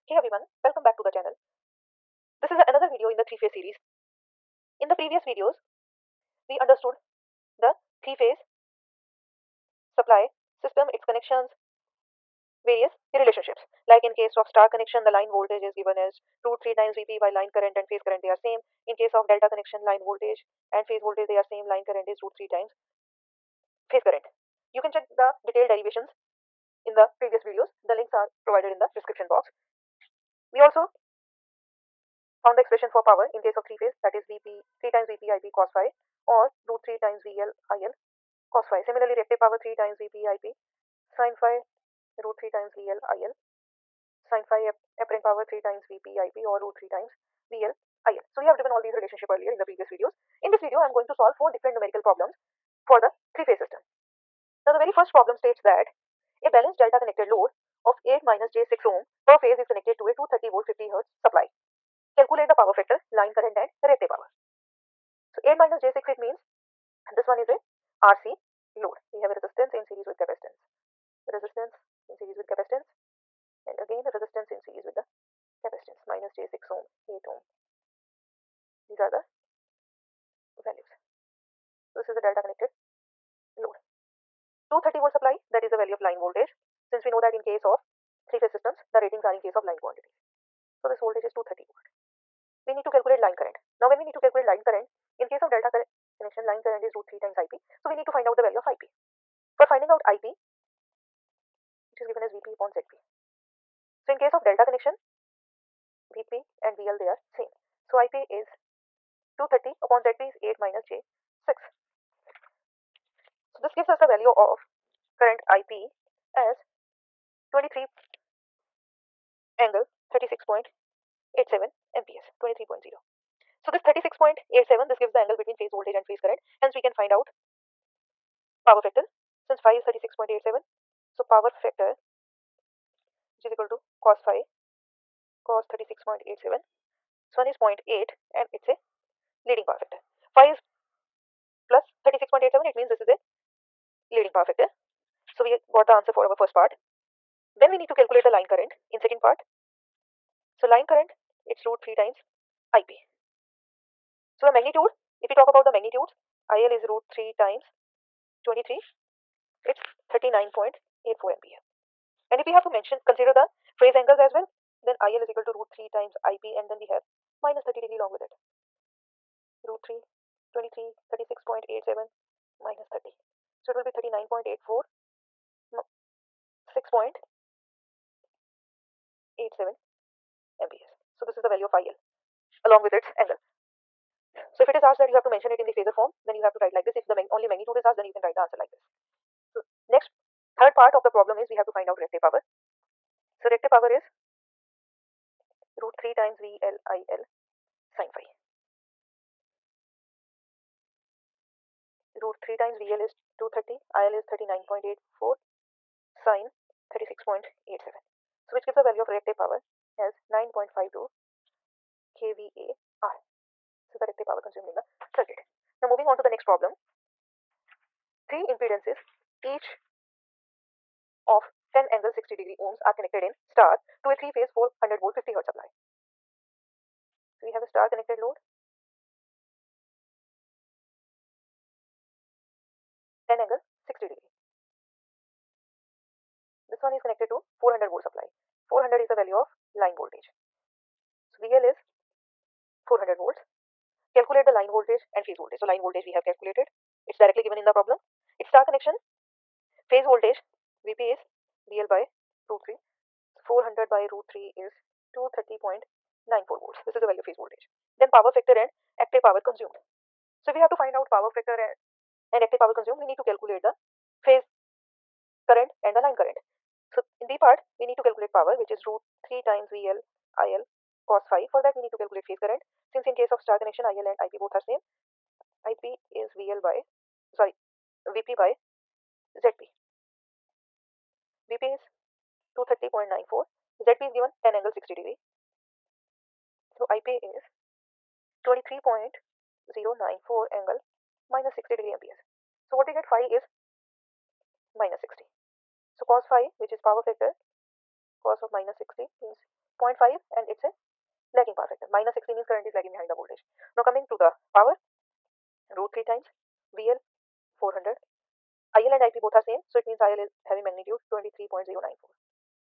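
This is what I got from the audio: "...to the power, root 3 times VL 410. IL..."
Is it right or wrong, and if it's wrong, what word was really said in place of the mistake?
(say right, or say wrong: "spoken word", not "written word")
wrong: "400", not "410".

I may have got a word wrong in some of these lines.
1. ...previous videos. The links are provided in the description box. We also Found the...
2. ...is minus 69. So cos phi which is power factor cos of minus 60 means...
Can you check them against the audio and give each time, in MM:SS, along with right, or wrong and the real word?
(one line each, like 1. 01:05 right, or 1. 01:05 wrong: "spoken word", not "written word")
1. 00:27 right
2. 04:53 wrong: "60", not "69".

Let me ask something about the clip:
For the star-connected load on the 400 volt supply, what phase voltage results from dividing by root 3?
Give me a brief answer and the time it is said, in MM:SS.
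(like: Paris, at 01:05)
230.94 volts, at 04:15.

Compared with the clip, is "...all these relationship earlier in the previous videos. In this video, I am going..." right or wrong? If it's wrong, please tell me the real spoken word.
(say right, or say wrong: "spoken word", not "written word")
right.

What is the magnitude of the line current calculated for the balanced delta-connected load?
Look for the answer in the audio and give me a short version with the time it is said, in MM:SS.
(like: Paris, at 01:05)
39.84 amperes, at 02:40.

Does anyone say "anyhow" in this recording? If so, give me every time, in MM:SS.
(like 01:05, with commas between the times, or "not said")
not said.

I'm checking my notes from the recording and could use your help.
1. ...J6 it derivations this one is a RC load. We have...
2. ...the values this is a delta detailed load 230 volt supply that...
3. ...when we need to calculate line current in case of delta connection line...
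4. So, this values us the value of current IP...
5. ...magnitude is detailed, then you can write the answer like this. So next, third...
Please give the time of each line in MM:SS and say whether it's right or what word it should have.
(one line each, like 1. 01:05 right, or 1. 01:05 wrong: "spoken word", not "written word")
1. 01:05 wrong: "means", not "derivations"
2. 01:19 wrong: "connected", not "detailed"
3. 01:33 right
4. 01:53 wrong: "gives", not "values"
5. 03:07 wrong: "asked", not "detailed".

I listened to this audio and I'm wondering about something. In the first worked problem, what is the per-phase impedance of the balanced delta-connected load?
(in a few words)
8 - j6 ohm.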